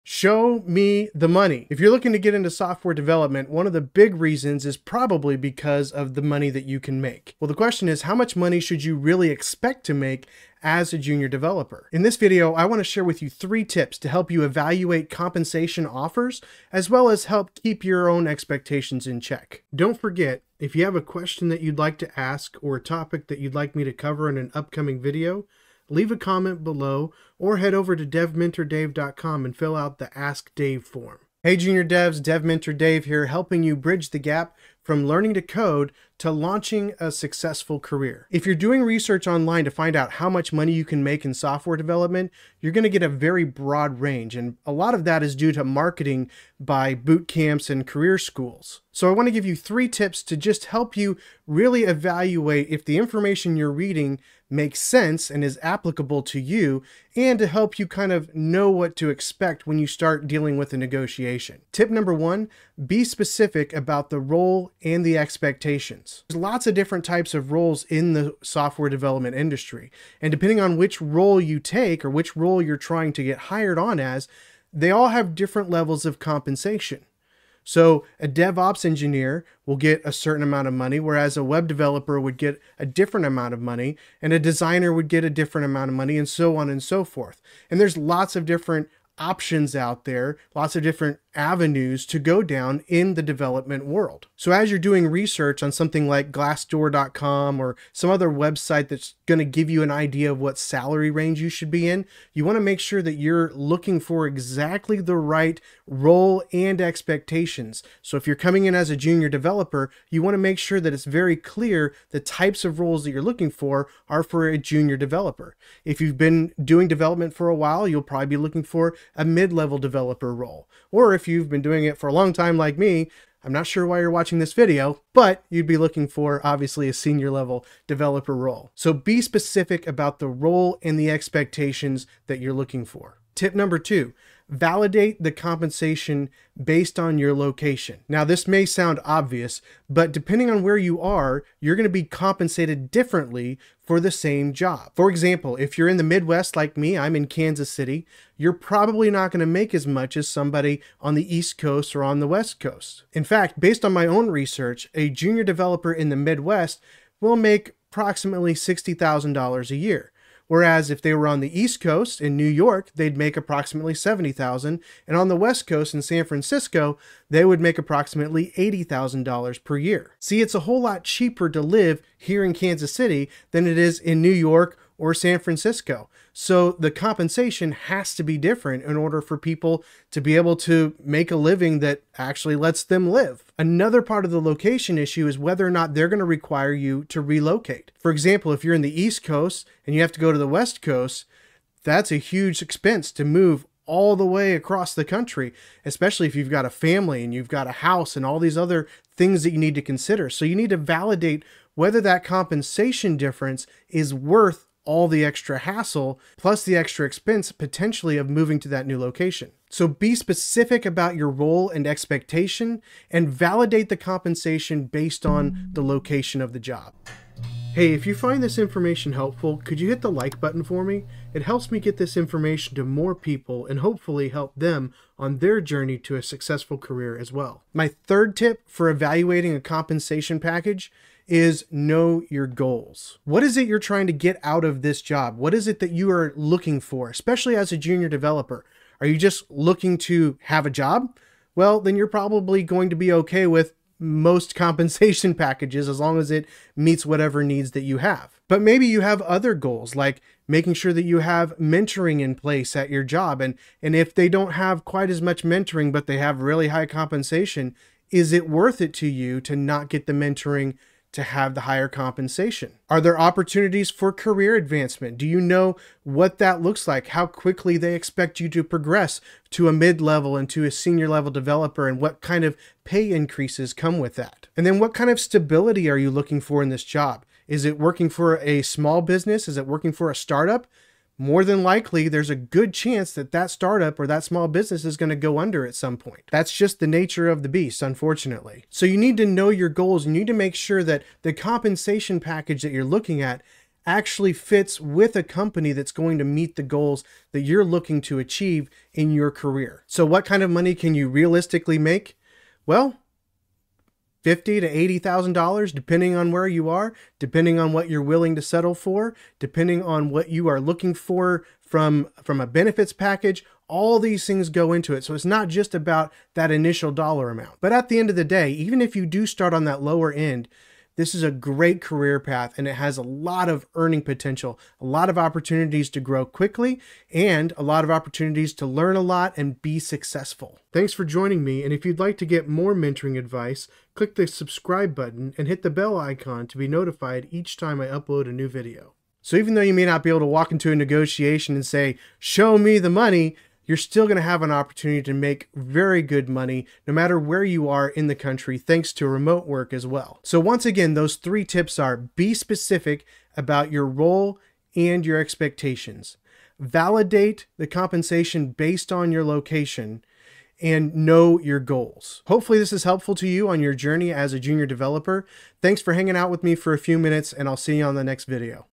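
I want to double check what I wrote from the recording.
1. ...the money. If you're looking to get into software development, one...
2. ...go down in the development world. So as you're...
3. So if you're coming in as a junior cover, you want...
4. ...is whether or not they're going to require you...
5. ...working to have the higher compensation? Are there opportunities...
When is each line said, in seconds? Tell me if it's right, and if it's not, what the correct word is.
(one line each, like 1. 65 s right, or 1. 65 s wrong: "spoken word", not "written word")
1. 1 s right
2. 92 s right
3. 108 s wrong: "developer", not "cover"
4. 185 s right
5. 260 s wrong: "mentoring", not "working".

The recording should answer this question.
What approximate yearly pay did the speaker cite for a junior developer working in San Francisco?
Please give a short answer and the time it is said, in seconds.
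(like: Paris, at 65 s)
$80,000, at 168 s.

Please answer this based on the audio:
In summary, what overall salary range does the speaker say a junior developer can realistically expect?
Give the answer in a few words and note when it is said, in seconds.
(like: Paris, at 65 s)
$50,000 to $80,000, at 304 s.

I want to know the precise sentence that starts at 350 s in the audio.
So, once again, those three tips are be specific about your role and your expectations, validate the compensation based on your location.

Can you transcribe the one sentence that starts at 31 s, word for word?
Hey, Junior Devs, Dev Mentor Dave here, helping you bridge the gap from learning to code to launching a successful career.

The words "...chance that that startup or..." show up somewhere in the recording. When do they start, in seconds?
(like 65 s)
282 s.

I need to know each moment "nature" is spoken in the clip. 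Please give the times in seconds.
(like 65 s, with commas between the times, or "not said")
286 s.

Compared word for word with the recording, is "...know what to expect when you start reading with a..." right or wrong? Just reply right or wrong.
wrong.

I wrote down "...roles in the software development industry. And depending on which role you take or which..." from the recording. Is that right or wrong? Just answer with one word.
right.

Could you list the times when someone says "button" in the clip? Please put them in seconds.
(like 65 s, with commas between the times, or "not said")
220 s, 334 s.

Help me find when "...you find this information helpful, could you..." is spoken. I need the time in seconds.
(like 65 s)
218 s.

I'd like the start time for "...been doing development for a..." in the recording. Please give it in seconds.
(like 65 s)
116 s.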